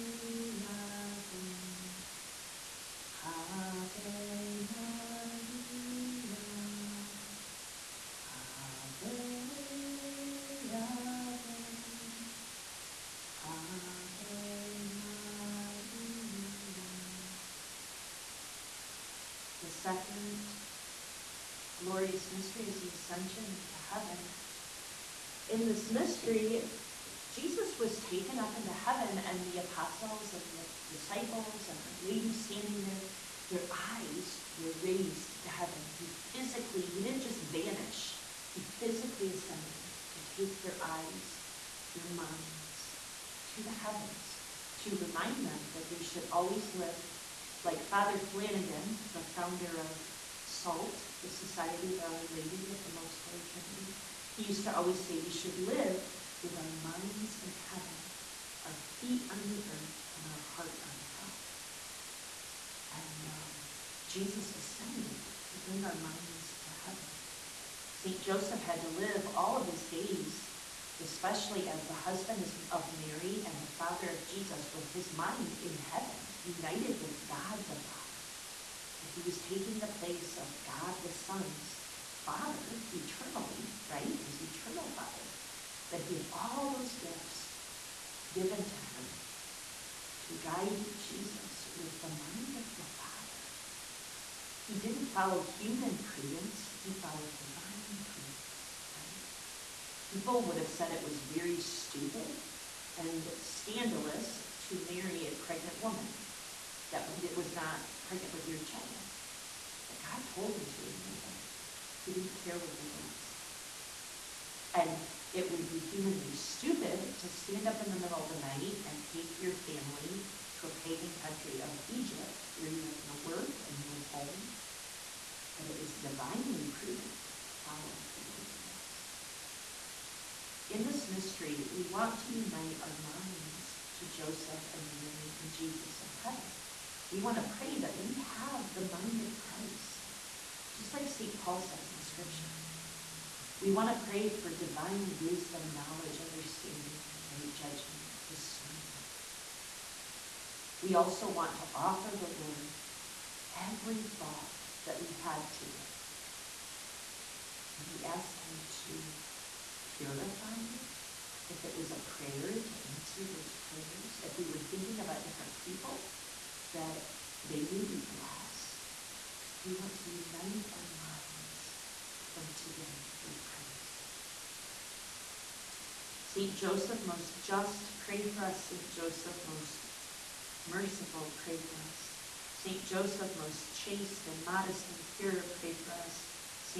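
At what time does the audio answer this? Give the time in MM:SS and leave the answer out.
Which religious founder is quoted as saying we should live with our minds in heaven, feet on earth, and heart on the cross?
00:47.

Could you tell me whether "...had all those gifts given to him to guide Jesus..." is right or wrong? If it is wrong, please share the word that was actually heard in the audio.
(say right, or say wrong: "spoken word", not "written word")
right.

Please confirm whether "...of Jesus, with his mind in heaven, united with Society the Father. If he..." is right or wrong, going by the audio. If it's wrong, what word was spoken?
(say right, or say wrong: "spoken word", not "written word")
wrong: "God", not "Society".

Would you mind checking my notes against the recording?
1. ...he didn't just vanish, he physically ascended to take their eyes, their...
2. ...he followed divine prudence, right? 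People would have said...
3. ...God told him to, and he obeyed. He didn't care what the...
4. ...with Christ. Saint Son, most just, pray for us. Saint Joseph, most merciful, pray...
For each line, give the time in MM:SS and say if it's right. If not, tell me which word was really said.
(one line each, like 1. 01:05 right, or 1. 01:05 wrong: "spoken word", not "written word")
1. 00:36 right
2. 01:36 right
3. 01:49 right
4. 02:53 wrong: "Joseph", not "Son".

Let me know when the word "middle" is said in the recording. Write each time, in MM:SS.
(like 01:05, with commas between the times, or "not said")
01:57.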